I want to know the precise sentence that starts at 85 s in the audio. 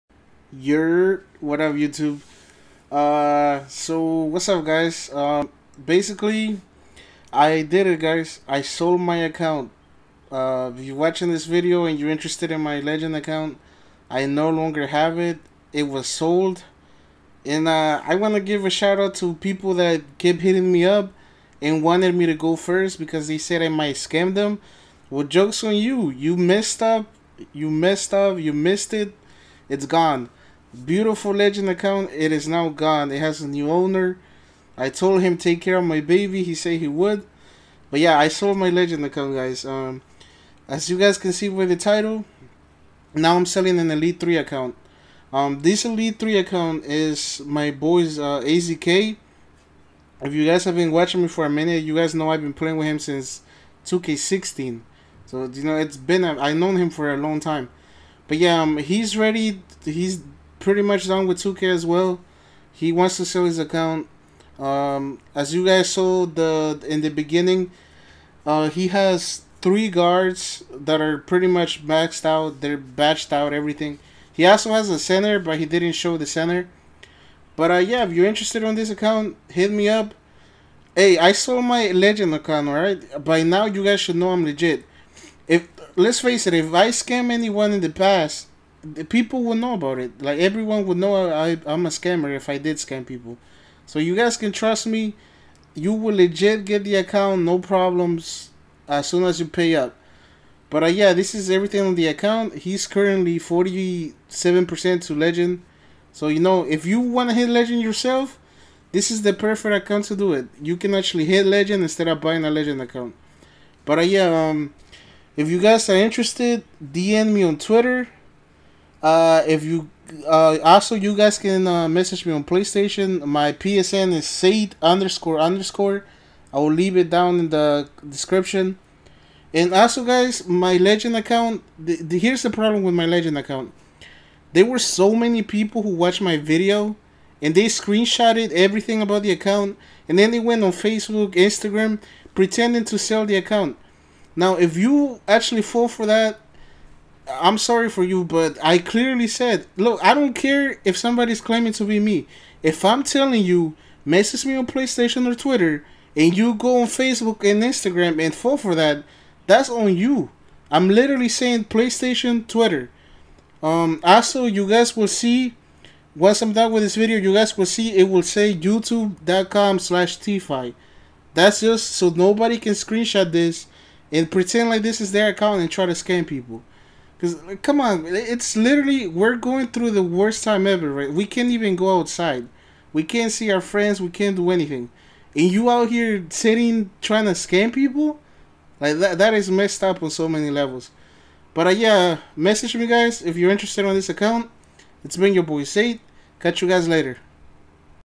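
If Let's face it, if I scam anyone in the past, the people will know about it.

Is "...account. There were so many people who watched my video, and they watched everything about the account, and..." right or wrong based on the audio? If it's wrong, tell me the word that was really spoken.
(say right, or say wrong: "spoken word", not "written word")
wrong: "screenshotted", not "watched".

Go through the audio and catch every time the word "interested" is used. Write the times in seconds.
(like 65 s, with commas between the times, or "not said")
12 s, 78 s, 115 s, 193 s.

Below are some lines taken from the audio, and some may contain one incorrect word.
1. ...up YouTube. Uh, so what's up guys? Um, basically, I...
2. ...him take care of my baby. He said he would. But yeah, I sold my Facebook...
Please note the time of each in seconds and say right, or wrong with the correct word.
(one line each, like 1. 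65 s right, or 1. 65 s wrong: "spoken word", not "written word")
1. 1 s right
2. 35 s wrong: "Legend", not "Facebook".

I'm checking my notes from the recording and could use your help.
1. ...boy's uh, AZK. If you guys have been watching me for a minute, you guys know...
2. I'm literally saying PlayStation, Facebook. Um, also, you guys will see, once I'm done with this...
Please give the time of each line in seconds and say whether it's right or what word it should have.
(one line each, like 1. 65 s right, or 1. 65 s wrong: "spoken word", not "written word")
1. 47 s right
2. 160 s wrong: "Twitter", not "Facebook".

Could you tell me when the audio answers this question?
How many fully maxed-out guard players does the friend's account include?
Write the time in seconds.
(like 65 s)
69 s.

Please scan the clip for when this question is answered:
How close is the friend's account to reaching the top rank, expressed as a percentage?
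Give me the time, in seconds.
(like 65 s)
103 s.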